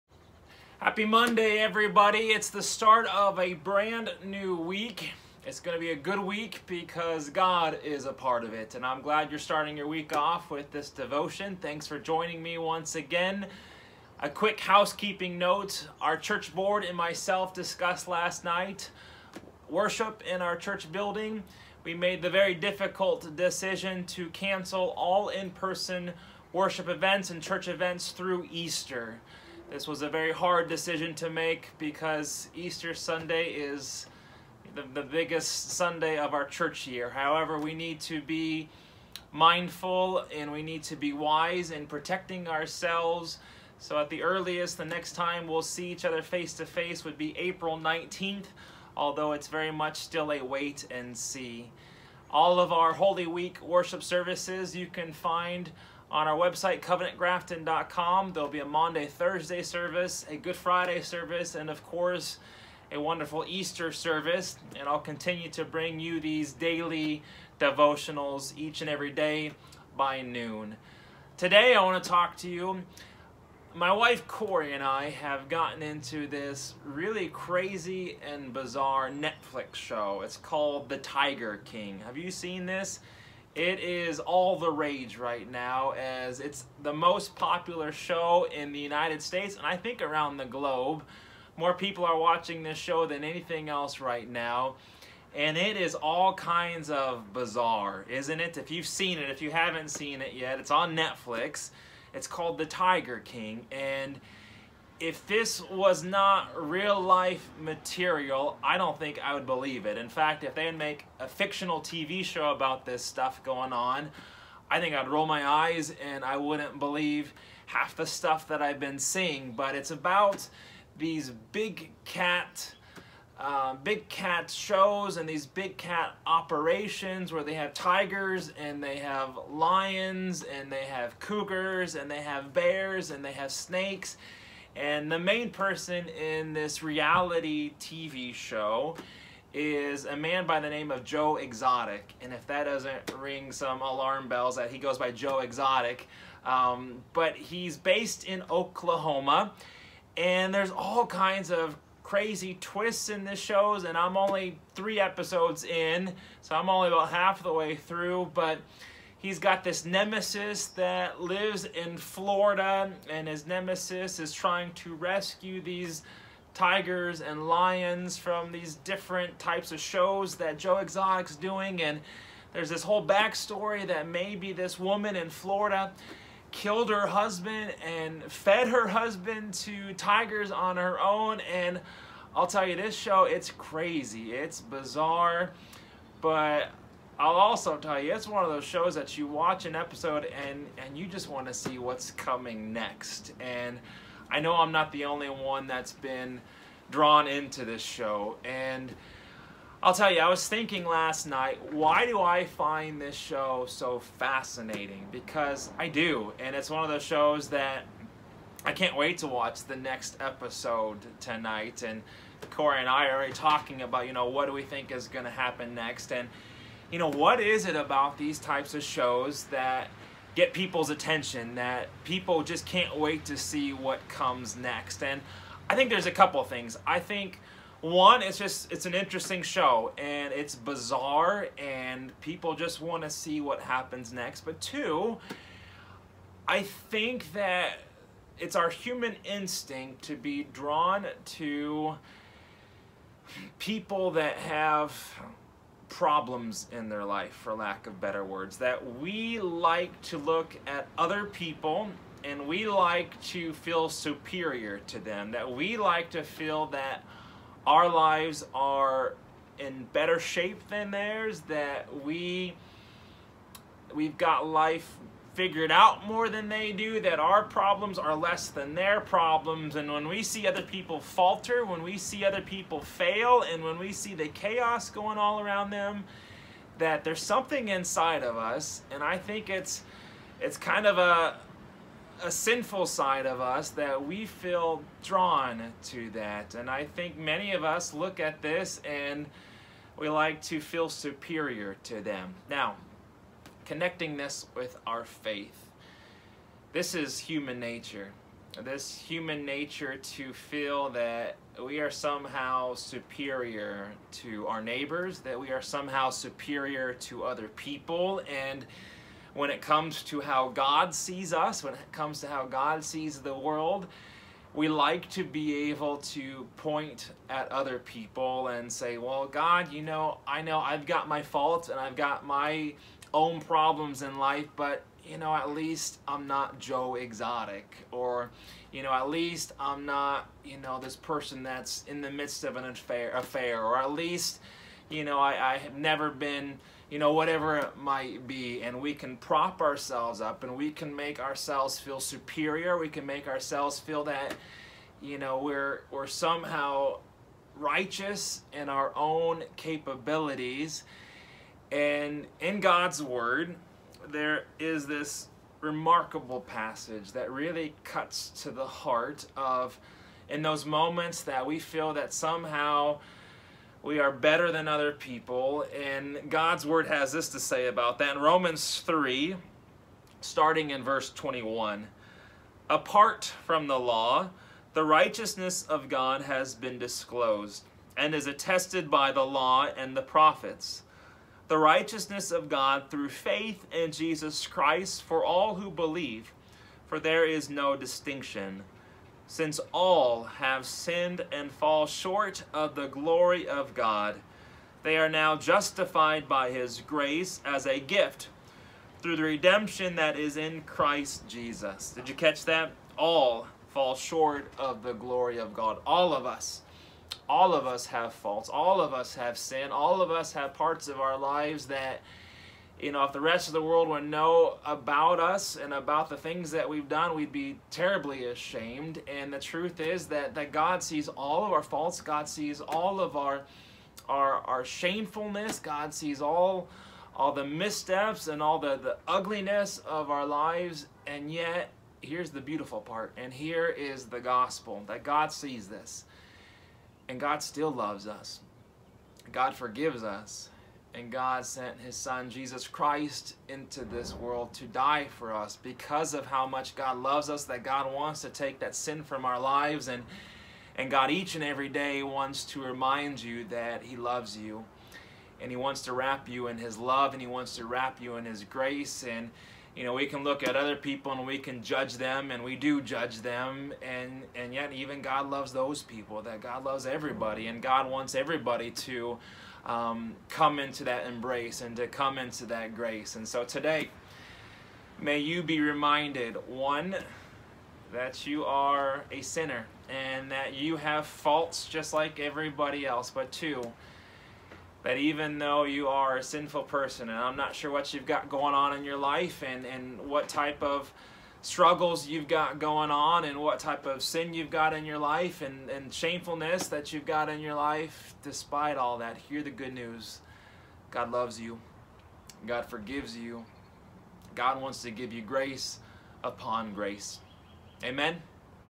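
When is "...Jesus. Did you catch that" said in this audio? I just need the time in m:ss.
6:41.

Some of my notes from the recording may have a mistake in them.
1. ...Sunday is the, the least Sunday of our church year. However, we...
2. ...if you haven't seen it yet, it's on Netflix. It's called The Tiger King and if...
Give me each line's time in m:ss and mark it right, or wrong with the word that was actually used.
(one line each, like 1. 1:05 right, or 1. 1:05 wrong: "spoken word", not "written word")
1. 0:32 wrong: "biggest", not "least"
2. 1:39 right.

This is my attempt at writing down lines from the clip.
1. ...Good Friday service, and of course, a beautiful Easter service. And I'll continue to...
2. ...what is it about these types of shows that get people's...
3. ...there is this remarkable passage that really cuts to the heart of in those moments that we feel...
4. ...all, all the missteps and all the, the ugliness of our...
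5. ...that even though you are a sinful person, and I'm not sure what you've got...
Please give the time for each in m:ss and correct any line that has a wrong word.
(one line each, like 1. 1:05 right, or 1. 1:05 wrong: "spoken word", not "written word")
1. 1:00 wrong: "wonderful", not "beautiful"
2. 3:37 right
3. 5:54 right
4. 7:06 right
5. 8:04 right.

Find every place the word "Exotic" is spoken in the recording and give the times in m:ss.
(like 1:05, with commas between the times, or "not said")
2:21, 2:25, 2:50, 5:26.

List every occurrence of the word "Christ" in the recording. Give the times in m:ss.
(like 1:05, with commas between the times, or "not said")
6:24, 6:40, 7:22.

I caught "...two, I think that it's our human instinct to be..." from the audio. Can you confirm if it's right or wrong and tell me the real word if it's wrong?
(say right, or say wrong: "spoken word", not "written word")
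right.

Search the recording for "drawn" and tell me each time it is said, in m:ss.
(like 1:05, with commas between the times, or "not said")
3:16, 4:00, 4:45.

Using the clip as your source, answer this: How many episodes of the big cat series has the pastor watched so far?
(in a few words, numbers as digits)
3.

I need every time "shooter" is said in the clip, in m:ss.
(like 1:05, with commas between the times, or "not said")
not said.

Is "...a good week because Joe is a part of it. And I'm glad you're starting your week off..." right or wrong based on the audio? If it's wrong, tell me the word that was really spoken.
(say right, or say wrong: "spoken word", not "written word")
wrong: "God", not "Joe".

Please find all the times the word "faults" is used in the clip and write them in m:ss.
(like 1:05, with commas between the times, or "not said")
5:21, 6:48, 7:01, 8:01.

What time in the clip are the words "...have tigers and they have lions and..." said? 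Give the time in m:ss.
2:07.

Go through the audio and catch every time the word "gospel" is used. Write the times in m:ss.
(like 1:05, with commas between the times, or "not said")
7:14.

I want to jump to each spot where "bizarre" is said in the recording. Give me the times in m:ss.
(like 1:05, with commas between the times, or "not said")
1:18, 1:37, 3:04, 3:50.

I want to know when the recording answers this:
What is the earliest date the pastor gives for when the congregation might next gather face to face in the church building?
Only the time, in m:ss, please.
0:47.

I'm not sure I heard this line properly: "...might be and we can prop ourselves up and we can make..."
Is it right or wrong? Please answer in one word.
right.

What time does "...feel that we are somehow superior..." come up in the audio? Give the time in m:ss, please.
5:00.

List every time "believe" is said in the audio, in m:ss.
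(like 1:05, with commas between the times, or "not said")
1:49, 1:56, 6:25.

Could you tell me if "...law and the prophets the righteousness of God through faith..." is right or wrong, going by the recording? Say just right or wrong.
right.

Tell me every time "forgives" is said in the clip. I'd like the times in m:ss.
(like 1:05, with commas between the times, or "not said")
7:19, 8:22.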